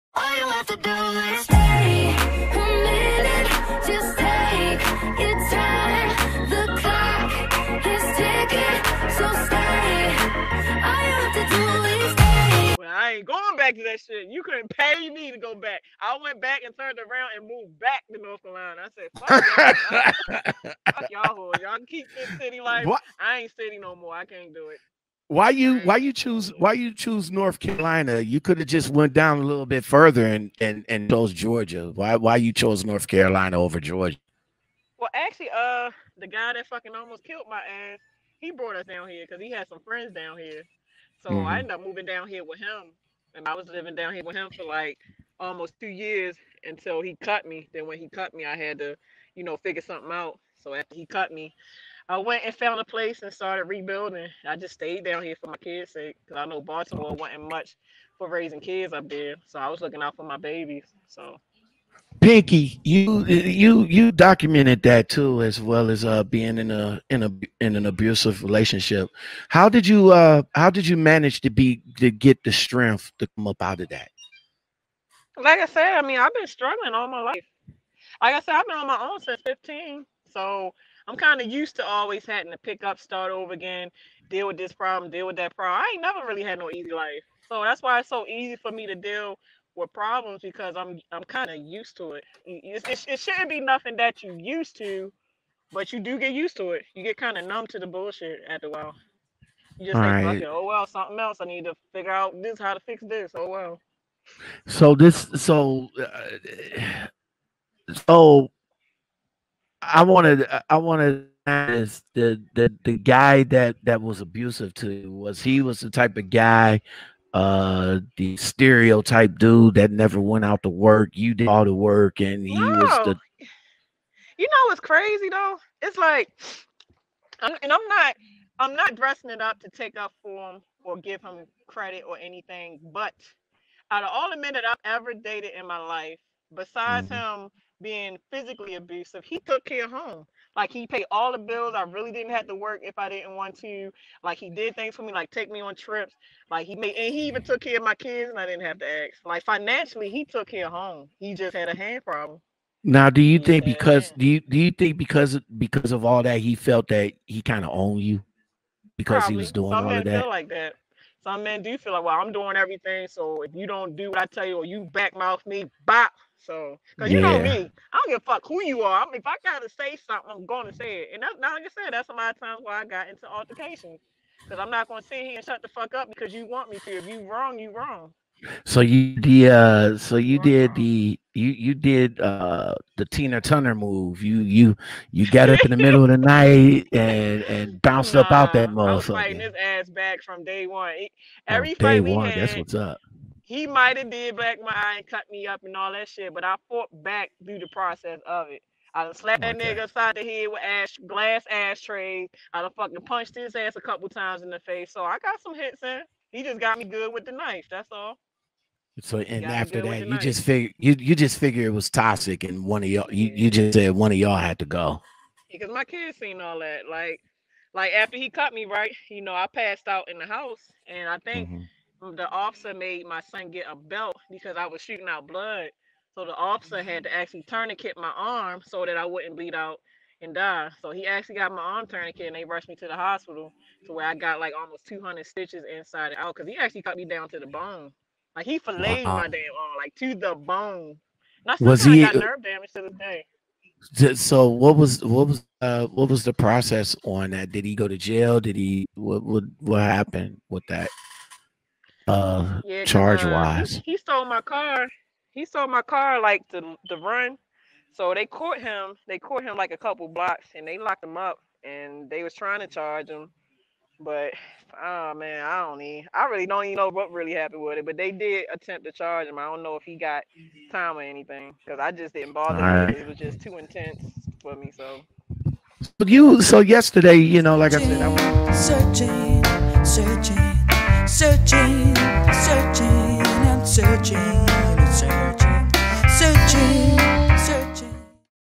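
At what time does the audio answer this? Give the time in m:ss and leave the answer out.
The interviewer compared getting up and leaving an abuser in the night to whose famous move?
3:03.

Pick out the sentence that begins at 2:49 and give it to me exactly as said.
I mean, if I gotta say something, I'm gonna say it.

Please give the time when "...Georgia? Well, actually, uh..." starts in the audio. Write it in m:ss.
0:33.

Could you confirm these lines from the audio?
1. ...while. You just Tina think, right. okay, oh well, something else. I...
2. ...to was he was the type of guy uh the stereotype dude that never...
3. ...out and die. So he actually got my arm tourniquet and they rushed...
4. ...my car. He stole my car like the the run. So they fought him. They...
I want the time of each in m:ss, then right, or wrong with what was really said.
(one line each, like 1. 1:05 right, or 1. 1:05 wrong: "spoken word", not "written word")
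1. 1:38 wrong: "All", not "Tina"
2. 1:54 right
3. 3:49 right
4. 4:14 wrong: "caught", not "fought".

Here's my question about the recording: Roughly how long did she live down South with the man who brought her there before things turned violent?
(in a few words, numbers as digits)
almost 2 years.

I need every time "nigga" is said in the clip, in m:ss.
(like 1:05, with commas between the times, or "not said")
3:19.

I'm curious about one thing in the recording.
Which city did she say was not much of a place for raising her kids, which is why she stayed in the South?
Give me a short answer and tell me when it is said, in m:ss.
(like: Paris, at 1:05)
Baltimore, at 0:56.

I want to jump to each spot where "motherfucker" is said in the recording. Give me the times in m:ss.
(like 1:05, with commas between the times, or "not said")
3:08.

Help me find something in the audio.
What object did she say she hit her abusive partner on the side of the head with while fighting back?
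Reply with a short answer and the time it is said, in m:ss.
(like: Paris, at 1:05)
glass ashtray, at 3:21.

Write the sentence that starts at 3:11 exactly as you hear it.
Every oh, day fight we one, had, that's what's up.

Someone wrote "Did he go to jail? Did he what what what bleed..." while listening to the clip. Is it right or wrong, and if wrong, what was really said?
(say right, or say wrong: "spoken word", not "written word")
wrong: "happened", not "bleed".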